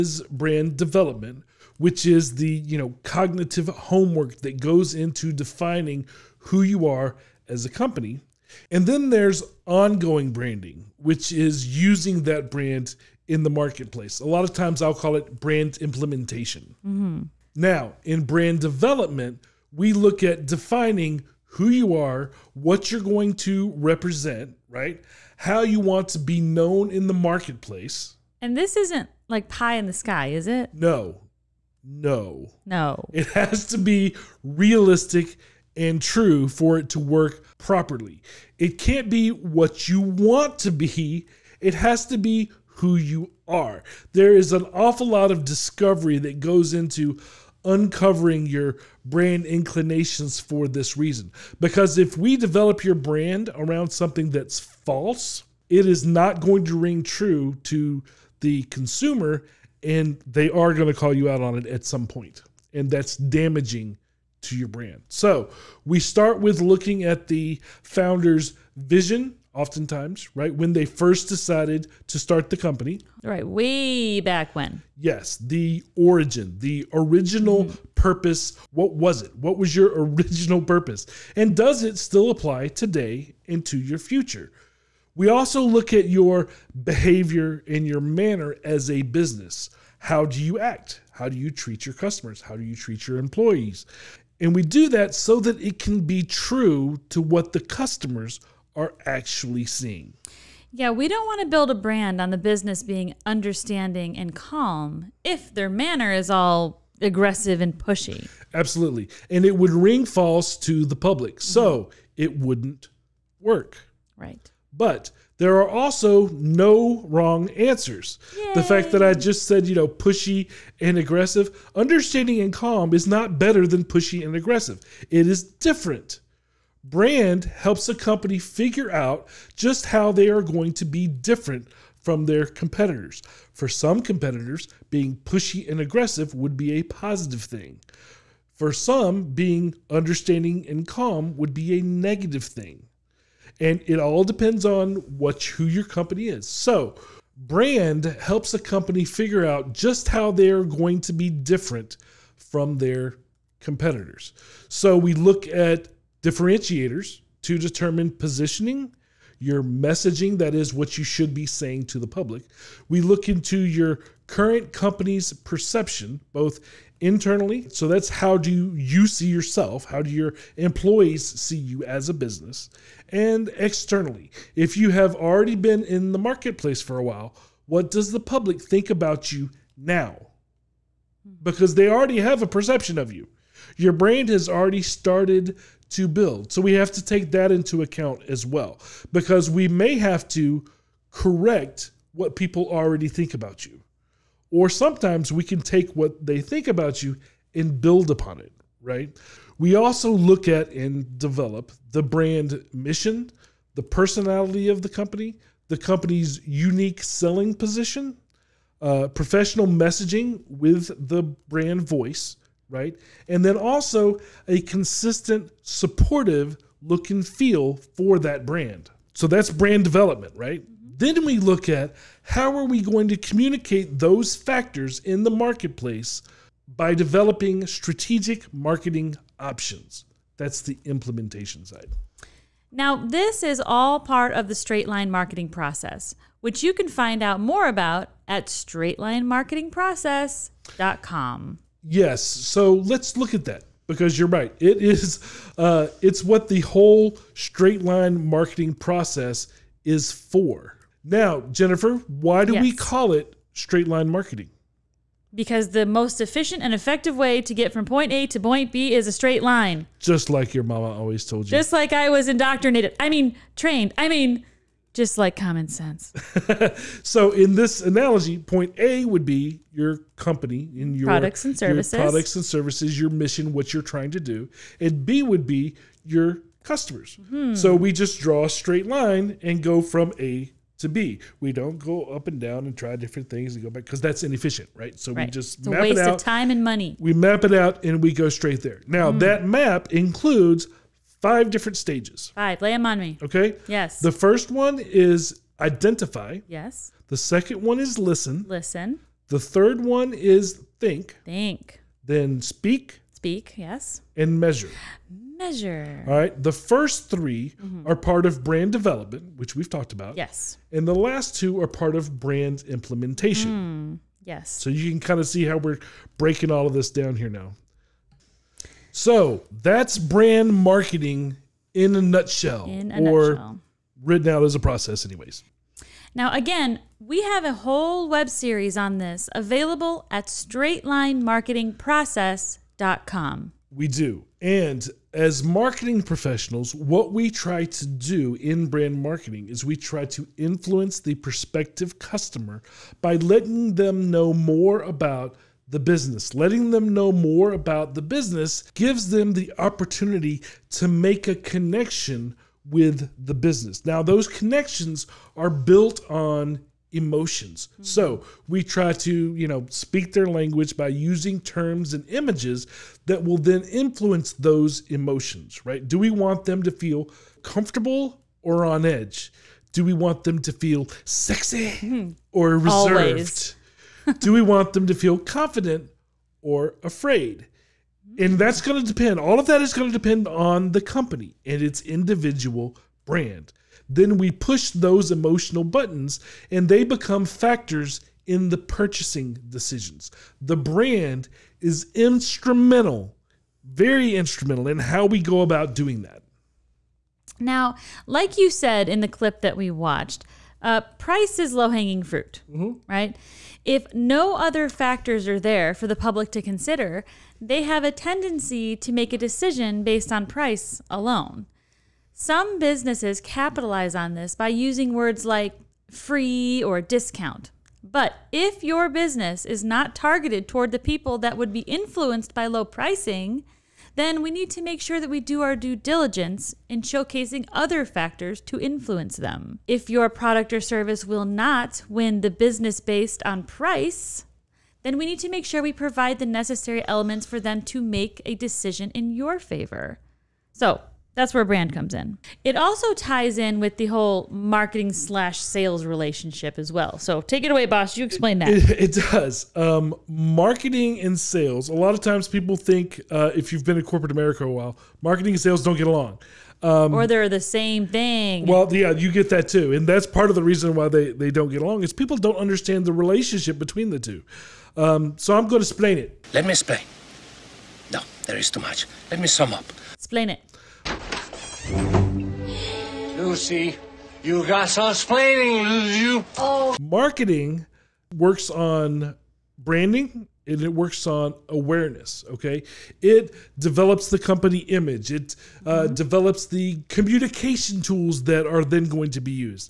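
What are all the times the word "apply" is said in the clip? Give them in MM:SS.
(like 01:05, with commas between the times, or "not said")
01:22.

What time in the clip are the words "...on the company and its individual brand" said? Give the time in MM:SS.
06:20.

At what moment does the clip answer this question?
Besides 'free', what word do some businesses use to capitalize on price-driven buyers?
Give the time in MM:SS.
06:56.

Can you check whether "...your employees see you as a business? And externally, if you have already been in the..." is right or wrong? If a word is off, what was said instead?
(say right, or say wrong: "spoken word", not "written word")
right.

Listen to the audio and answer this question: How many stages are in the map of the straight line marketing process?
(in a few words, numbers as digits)
5.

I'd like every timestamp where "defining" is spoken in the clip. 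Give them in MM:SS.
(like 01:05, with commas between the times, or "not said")
00:05, 00:20.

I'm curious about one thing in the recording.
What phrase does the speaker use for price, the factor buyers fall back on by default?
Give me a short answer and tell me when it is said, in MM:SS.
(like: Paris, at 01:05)
low hanging fruit, at 06:41.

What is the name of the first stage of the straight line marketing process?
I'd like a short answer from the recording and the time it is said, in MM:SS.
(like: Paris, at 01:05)
identify, at 04:55.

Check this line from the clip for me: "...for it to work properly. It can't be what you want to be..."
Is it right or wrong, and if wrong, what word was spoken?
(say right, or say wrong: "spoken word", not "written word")
right.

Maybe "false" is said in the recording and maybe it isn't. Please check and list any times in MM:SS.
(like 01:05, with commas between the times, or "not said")
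00:54, 01:50.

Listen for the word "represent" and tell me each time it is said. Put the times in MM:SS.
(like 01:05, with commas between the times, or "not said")
00:23.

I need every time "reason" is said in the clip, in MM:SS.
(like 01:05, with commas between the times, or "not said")
00:50, 07:40.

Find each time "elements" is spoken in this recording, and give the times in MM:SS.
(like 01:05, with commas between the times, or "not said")
07:16.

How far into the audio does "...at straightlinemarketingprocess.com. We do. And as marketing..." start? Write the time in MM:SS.
05:30.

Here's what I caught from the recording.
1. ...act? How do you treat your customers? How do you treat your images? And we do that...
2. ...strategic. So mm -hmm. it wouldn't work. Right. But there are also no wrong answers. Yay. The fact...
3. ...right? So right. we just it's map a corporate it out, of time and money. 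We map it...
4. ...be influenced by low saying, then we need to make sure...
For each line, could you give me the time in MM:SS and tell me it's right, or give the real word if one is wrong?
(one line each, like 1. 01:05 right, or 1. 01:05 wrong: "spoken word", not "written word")
1. 01:30 wrong: "employees", not "images"
2. 01:50 wrong: "public", not "strategic"
3. 04:44 wrong: "waste", not "corporate"
4. 07:01 wrong: "pricing", not "saying".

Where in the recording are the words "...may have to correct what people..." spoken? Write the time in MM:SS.
03:09.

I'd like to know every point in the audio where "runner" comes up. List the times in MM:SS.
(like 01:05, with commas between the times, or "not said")
not said.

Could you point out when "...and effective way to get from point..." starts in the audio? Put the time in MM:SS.
04:16.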